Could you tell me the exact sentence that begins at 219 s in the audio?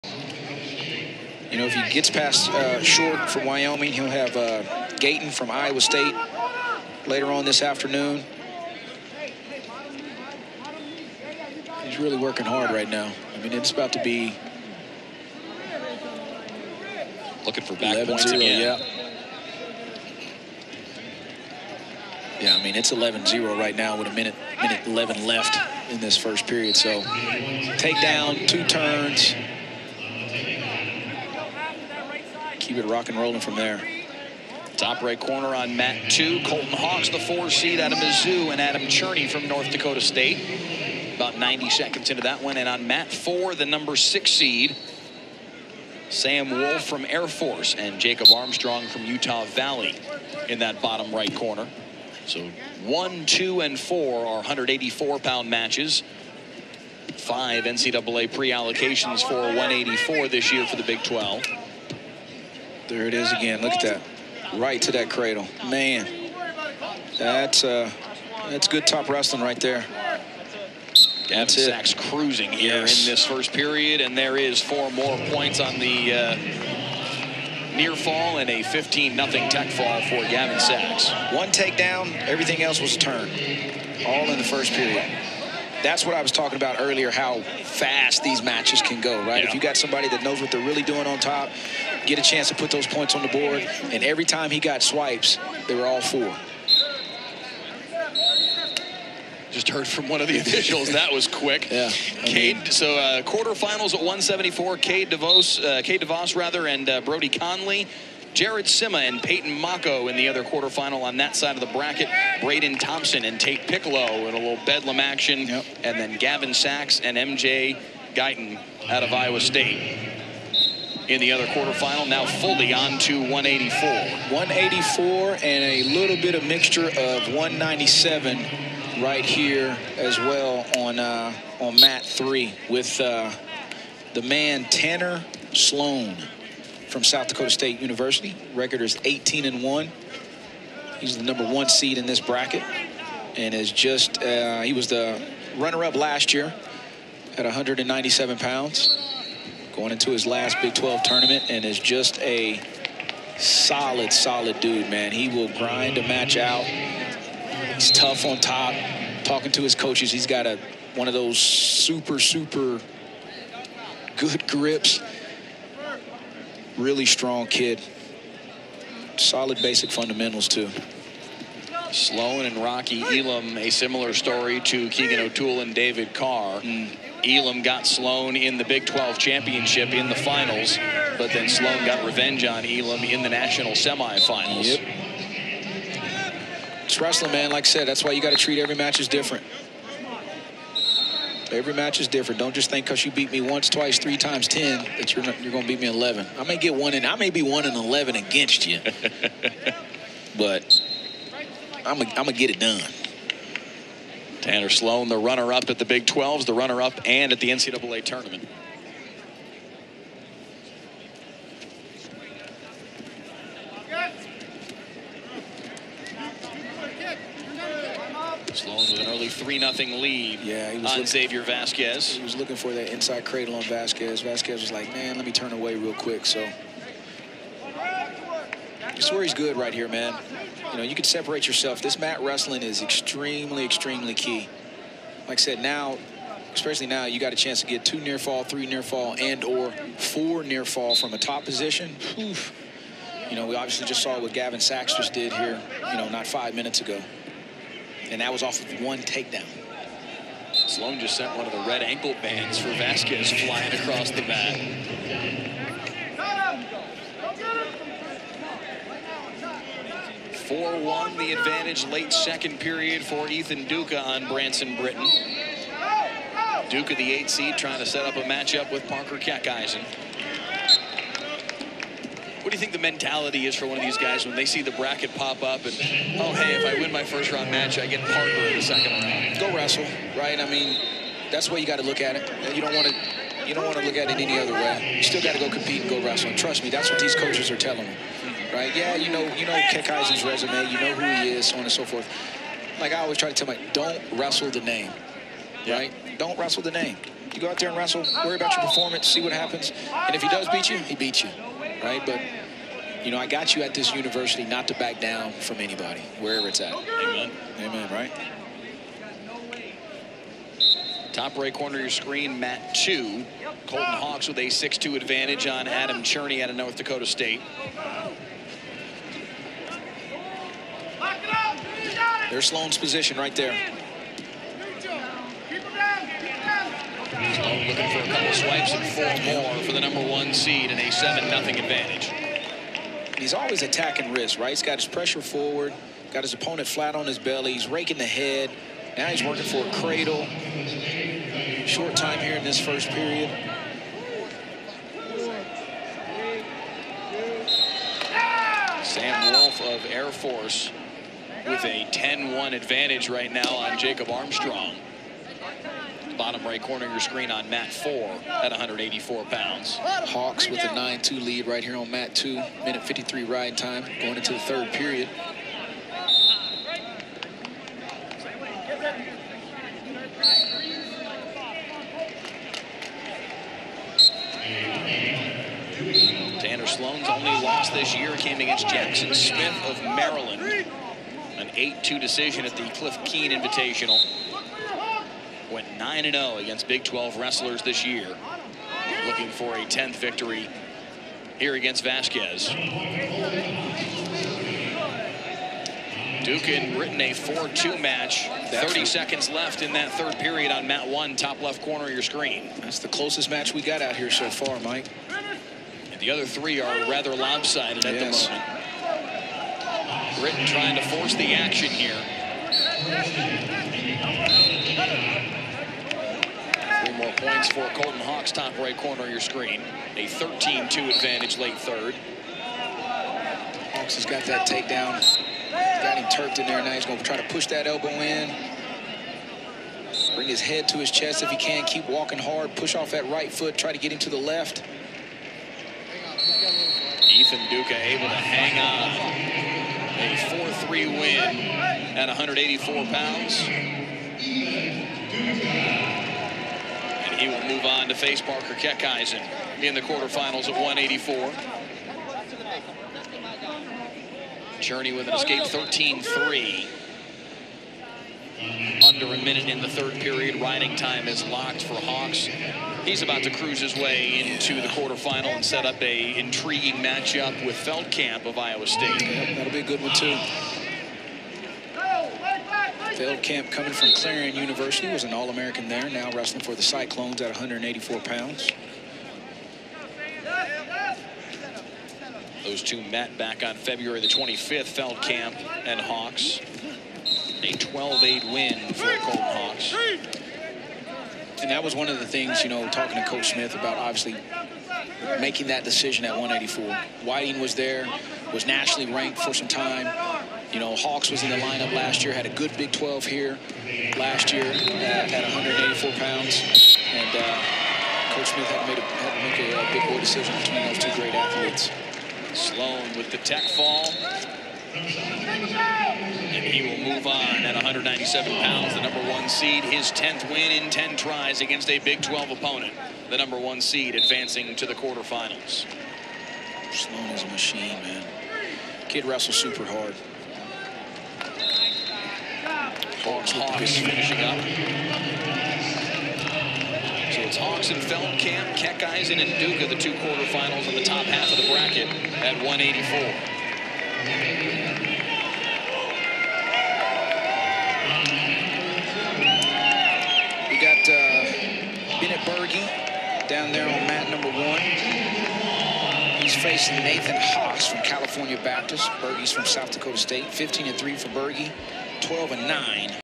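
3 nothing lead yeah, on looking, Xavier Vasquez.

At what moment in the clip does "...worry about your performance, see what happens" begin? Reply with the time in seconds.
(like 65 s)
298 s.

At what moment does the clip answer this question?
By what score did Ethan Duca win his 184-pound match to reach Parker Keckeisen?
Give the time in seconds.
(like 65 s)
440 s.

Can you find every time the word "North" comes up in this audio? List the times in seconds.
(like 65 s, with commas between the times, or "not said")
39 s, 316 s.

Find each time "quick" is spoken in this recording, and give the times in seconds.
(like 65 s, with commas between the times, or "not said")
101 s, 225 s.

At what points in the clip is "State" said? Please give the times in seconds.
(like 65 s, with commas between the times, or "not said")
5 s, 39 s, 119 s, 137 s, 317 s, 468 s, 559 s.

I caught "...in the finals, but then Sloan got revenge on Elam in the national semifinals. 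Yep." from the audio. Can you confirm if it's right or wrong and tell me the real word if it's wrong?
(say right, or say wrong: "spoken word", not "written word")
right.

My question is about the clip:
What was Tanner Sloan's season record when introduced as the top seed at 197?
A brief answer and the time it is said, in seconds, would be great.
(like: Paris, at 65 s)
18-1, at 139 s.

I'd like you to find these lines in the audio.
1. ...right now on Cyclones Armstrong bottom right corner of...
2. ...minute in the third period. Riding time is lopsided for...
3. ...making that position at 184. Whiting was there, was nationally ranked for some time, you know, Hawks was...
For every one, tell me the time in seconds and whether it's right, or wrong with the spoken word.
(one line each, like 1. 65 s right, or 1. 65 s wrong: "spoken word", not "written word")
1. 353 s wrong: "Jacob", not "Cyclones"
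2. 459 s wrong: "locked", not "lopsided"
3. 495 s wrong: "decision", not "position".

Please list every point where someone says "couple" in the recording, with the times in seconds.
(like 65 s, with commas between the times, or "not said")
328 s.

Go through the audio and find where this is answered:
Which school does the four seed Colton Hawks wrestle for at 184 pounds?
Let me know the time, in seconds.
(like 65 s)
37 s.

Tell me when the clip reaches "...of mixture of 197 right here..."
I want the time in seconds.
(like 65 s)
126 s.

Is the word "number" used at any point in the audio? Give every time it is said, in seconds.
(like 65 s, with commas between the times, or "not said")
43 s, 141 s, 329 s, 518 s, 523 s, 554 s.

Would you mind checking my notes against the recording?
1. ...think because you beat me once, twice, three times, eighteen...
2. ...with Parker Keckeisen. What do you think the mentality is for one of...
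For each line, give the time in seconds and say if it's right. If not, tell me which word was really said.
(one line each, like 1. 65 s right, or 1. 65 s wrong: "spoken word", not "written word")
1. 192 s wrong: "ten", not "eighteen"
2. 268 s right.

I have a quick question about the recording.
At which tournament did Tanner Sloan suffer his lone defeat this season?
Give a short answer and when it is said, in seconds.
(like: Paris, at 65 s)
Cliff Keen Invitational, at 382 s.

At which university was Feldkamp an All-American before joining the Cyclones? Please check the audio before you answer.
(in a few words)
Clarion University.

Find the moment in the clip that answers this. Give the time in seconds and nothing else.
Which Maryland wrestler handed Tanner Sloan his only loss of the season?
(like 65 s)
378 s.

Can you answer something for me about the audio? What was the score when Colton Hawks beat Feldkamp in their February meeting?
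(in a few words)
12-8.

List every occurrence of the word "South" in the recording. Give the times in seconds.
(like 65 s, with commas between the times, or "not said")
137 s, 559 s.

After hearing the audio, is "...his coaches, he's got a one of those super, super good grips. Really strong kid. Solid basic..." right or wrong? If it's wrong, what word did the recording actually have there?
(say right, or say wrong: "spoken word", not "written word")
right.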